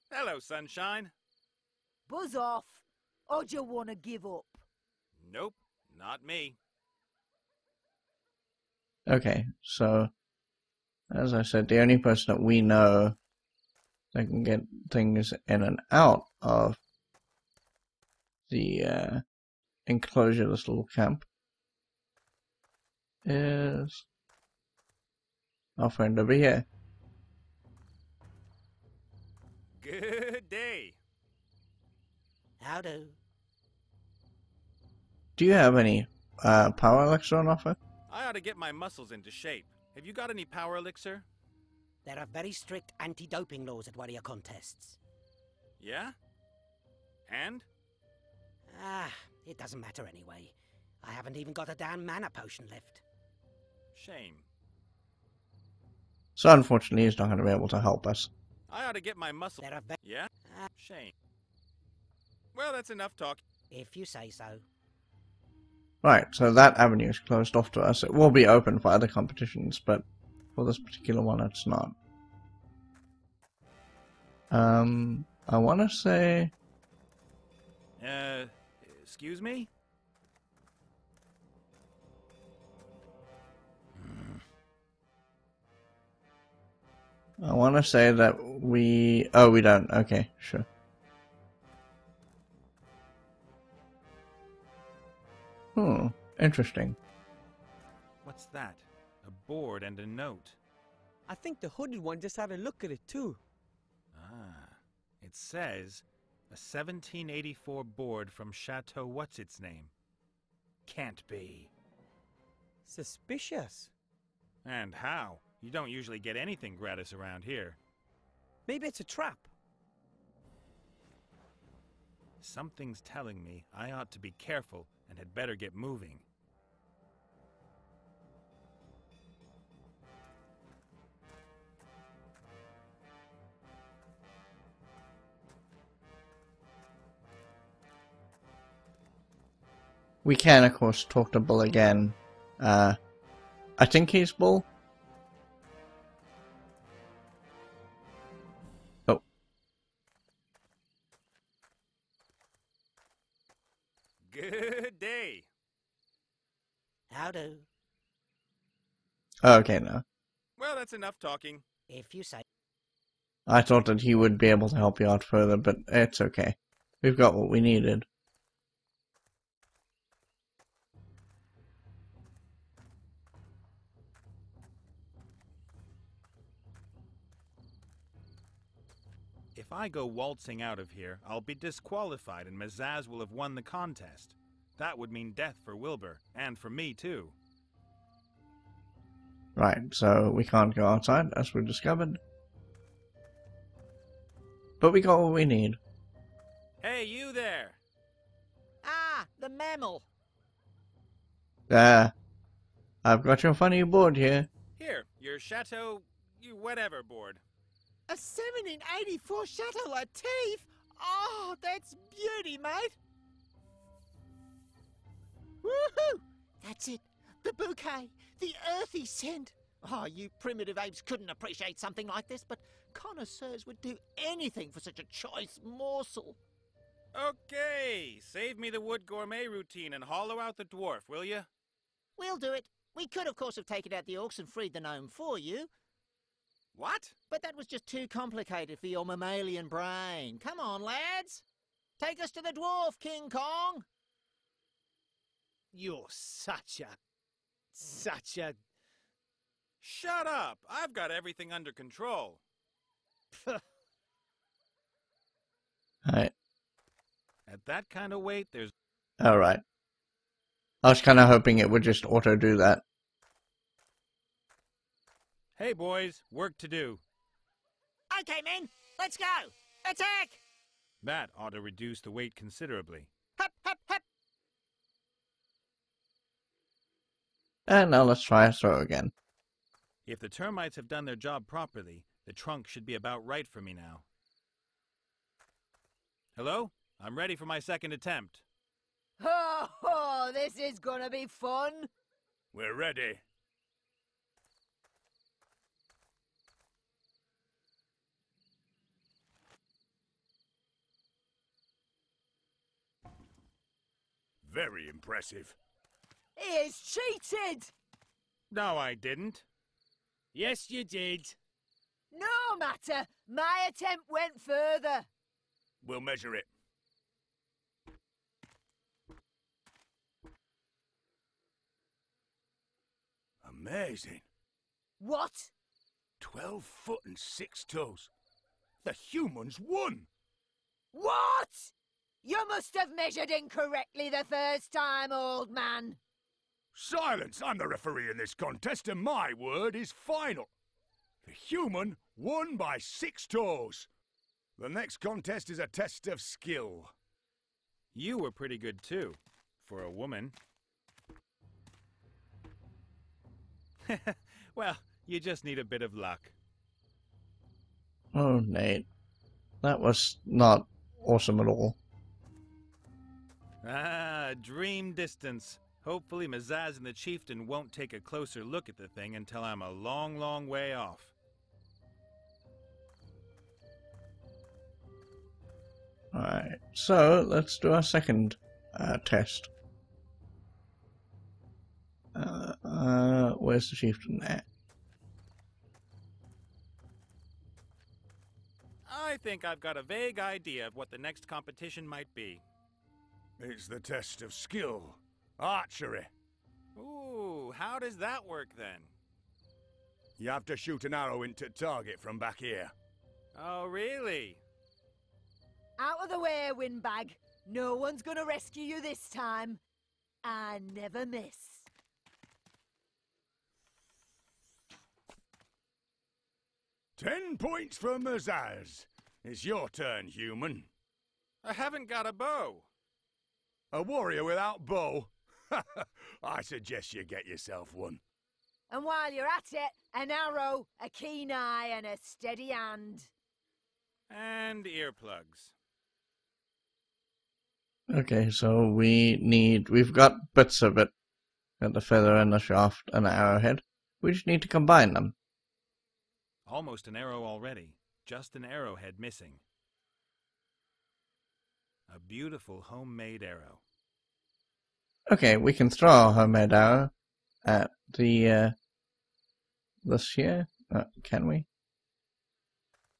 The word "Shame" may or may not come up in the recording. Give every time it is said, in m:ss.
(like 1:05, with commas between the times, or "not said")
0:53, 1:00.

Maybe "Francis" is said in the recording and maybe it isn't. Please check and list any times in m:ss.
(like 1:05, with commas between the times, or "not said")
not said.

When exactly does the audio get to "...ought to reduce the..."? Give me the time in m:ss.
4:31.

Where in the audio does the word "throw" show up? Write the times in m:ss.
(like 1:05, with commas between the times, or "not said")
4:38, 7:35.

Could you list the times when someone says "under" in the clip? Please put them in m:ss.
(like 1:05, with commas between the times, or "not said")
4:11.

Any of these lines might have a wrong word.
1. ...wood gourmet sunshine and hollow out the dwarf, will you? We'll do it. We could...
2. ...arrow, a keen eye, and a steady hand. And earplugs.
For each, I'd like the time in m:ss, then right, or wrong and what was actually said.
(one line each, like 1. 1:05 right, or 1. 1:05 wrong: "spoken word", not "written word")
1. 3:48 wrong: "routine", not "sunshine"
2. 7:10 right.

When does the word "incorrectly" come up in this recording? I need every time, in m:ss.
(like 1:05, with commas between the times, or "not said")
5:33.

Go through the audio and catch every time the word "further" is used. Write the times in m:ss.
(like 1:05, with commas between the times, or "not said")
2:45, 5:14.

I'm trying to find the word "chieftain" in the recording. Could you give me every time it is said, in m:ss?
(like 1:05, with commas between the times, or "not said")
6:06, 6:23.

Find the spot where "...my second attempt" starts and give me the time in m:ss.
4:47.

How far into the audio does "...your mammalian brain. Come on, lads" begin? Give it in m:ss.
3:58.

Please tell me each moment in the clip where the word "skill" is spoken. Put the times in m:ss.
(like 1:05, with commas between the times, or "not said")
5:46, 6:34.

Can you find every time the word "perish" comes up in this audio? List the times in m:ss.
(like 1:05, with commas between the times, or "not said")
not said.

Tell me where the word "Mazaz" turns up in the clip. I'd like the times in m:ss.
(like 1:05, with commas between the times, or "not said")
3:02, 6:06, 6:57.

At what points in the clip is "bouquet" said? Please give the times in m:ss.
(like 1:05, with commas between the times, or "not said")
3:37.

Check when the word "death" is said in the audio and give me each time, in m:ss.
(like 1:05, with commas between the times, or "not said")
3:05.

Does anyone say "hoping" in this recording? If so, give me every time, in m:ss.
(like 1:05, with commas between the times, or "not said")
4:21.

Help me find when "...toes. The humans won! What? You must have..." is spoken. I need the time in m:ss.
5:27.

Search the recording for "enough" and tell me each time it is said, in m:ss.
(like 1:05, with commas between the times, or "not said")
1:02, 2:40.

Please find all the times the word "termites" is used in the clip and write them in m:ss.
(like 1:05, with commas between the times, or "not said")
4:40.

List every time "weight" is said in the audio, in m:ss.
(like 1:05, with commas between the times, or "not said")
4:18, 4:32.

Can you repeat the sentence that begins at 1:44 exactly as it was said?
Ah, it says a 1784 board from Chateau What's Its Name.